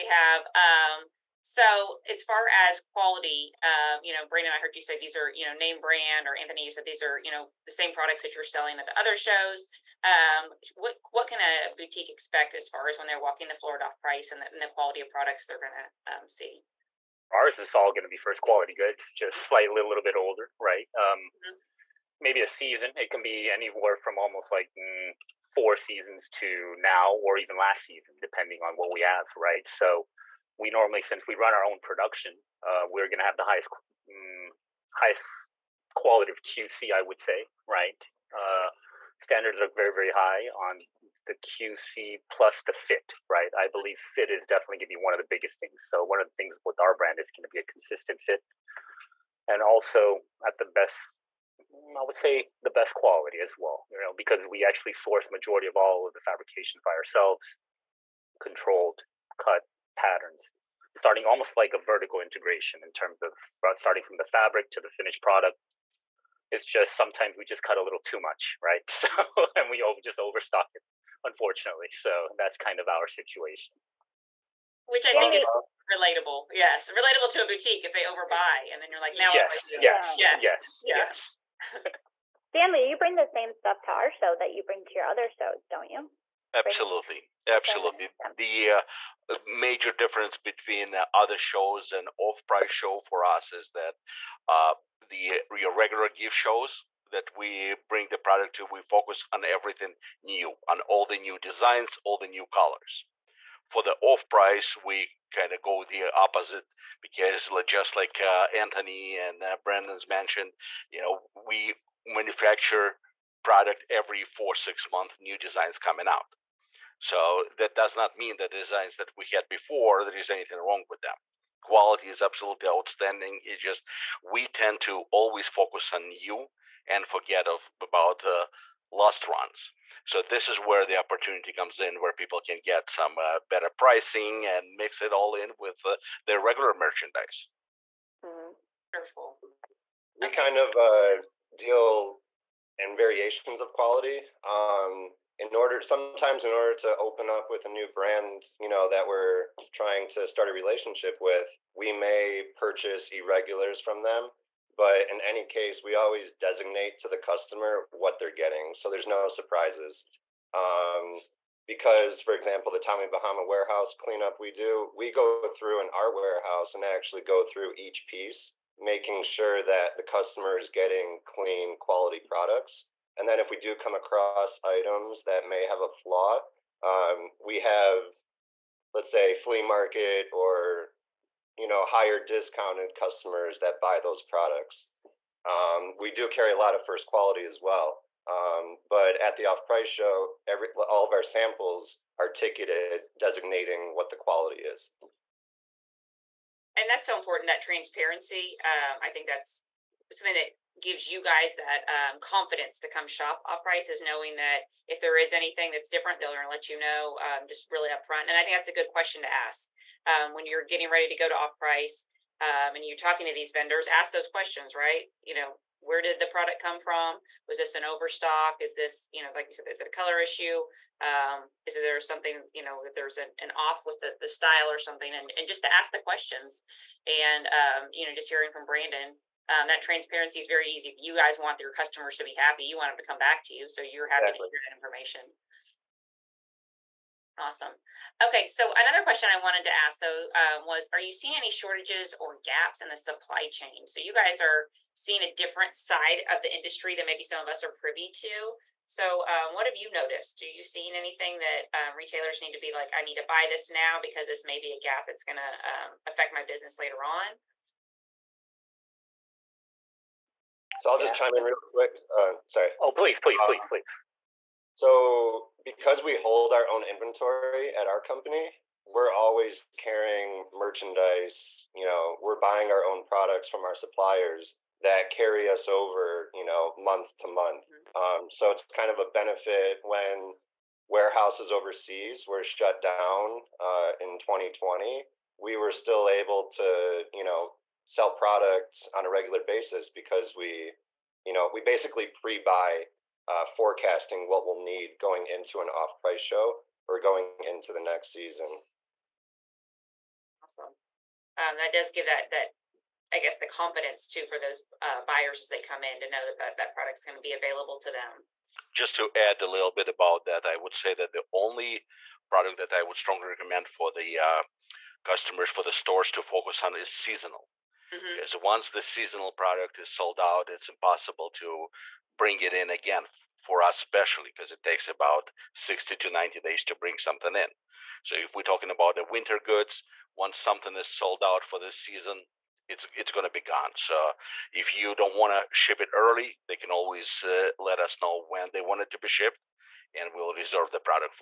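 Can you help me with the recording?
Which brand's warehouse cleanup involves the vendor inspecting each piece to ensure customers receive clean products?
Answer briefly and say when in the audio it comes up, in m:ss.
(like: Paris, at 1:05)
Tommy Bahama, at 2:42.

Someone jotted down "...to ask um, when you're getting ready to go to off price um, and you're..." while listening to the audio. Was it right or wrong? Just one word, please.
right.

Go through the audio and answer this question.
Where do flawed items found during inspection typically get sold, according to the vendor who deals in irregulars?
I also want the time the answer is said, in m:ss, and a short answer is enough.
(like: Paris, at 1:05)
Flea market, at 2:59.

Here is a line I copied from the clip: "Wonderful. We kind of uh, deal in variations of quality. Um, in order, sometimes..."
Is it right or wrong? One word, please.
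right.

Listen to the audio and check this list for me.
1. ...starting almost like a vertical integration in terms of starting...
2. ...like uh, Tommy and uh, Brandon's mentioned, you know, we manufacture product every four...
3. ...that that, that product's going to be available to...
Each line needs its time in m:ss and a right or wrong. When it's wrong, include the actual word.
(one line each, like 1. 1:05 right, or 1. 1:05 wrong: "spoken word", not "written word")
1. 1:00 right
2. 1:47 wrong: "Anthony", not "Tommy"
3. 5:06 right.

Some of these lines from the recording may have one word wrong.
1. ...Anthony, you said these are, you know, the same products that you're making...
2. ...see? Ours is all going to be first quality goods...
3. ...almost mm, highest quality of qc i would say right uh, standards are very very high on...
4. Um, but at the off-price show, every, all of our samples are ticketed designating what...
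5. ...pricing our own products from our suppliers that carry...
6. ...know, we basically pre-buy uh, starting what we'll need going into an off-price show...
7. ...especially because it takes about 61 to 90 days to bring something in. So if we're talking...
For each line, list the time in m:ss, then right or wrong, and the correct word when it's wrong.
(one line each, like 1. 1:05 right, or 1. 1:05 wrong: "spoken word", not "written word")
1. 0:06 wrong: "selling", not "making"
2. 0:16 right
3. 0:33 wrong: "highest", not "almost"
4. 3:08 right
5. 4:32 wrong: "buying", not "pricing"
6. 4:51 wrong: "forecasting", not "starting"
7. 5:23 wrong: "60", not "61".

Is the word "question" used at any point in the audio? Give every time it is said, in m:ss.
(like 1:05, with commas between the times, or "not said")
3:28, 3:34, 3:45, 3:59.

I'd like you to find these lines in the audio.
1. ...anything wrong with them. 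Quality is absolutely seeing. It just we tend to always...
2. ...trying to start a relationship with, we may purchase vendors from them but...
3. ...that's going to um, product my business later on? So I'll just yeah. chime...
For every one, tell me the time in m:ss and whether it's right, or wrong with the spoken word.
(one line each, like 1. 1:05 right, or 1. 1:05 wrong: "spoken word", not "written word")
1. 2:00 wrong: "outstanding", not "seeing"
2. 2:29 wrong: "irregulars", not "vendors"
3. 4:15 wrong: "affect", not "product".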